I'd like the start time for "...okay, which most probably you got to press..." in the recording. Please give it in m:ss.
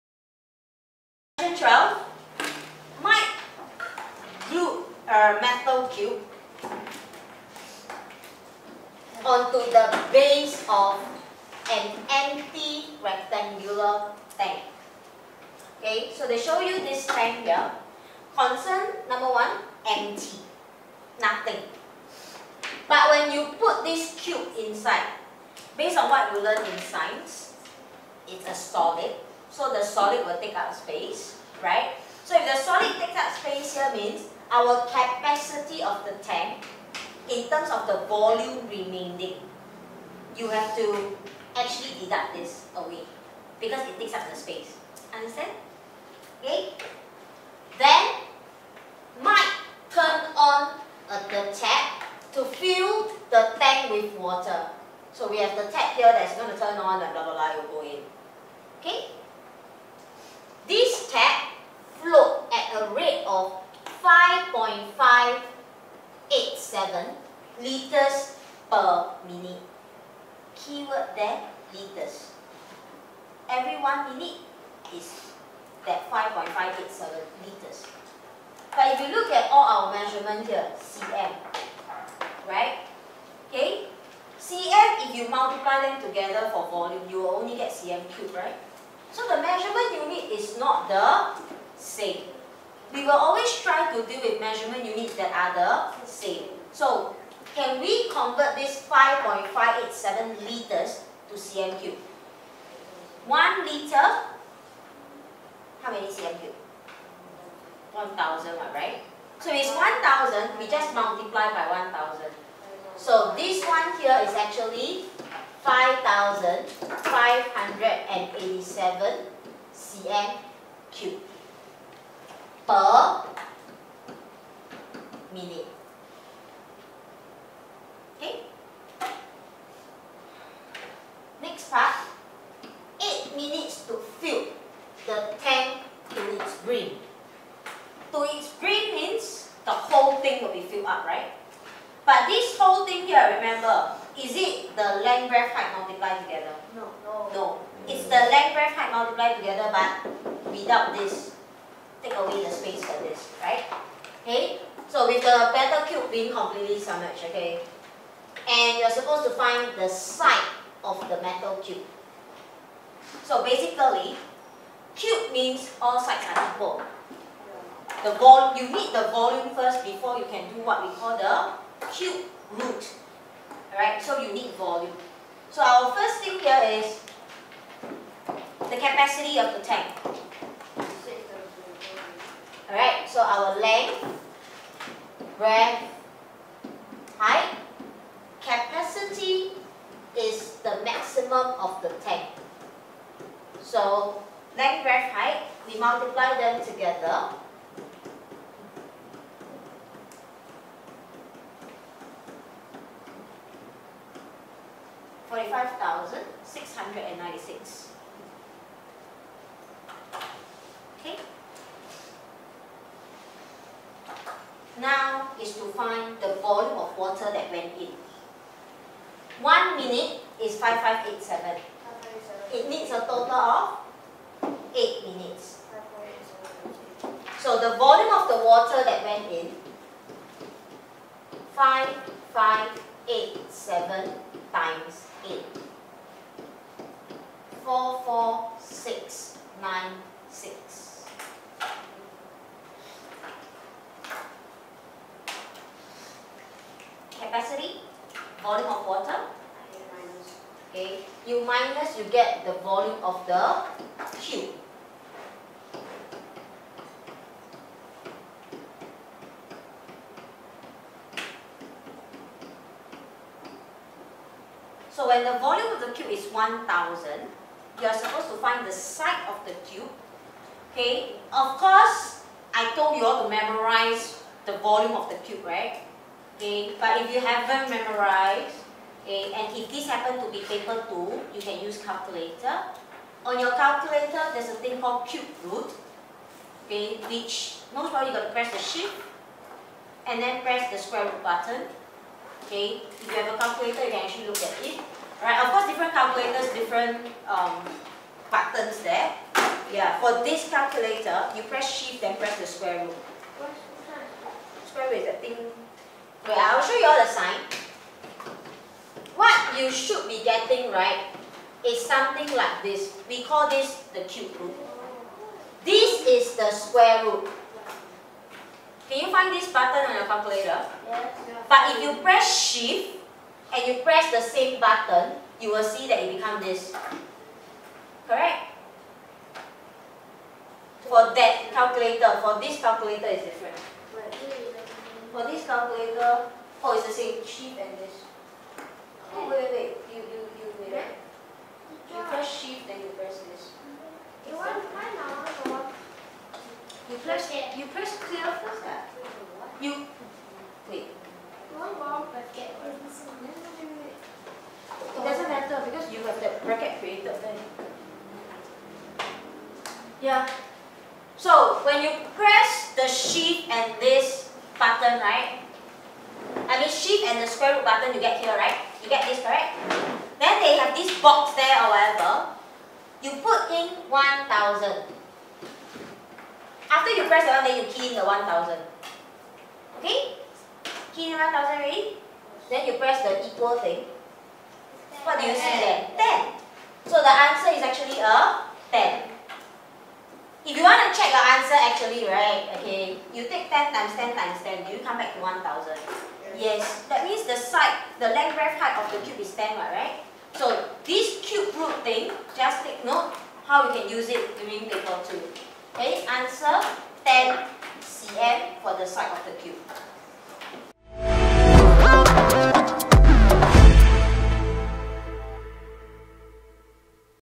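4:46.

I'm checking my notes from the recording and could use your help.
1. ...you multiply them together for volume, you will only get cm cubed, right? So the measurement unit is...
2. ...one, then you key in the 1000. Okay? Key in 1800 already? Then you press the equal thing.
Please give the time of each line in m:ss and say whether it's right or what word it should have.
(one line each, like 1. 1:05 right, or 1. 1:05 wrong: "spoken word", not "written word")
1. 1:25 right
2. 6:17 wrong: "1000", not "1800".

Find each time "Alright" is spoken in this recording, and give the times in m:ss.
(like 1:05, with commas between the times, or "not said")
2:53, 3:02.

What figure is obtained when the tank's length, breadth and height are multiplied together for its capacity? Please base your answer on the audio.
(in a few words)
45696.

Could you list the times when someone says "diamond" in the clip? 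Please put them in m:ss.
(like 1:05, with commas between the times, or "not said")
not said.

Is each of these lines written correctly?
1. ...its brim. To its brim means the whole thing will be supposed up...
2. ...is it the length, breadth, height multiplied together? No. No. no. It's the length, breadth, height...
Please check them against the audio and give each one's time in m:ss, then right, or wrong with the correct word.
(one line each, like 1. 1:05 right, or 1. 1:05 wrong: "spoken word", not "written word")
1. 2:16 wrong: "filled", not "supposed"
2. 2:24 right.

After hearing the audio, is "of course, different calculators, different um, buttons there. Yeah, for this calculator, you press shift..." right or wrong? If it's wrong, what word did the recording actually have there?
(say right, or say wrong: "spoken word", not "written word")
right.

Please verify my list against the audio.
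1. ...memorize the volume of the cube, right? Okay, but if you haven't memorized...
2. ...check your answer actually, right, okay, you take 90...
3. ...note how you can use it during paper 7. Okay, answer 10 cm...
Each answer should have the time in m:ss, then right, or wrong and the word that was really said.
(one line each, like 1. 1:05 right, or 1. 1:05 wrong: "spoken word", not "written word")
1. 4:33 right
2. 6:30 wrong: "10", not "90"
3. 6:42 wrong: "2", not "7".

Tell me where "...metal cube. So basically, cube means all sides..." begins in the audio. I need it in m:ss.
2:41.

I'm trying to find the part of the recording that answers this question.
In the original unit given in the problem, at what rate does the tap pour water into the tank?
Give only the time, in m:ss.
1:04.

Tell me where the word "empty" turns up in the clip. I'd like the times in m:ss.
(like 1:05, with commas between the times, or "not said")
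0:12, 0:19.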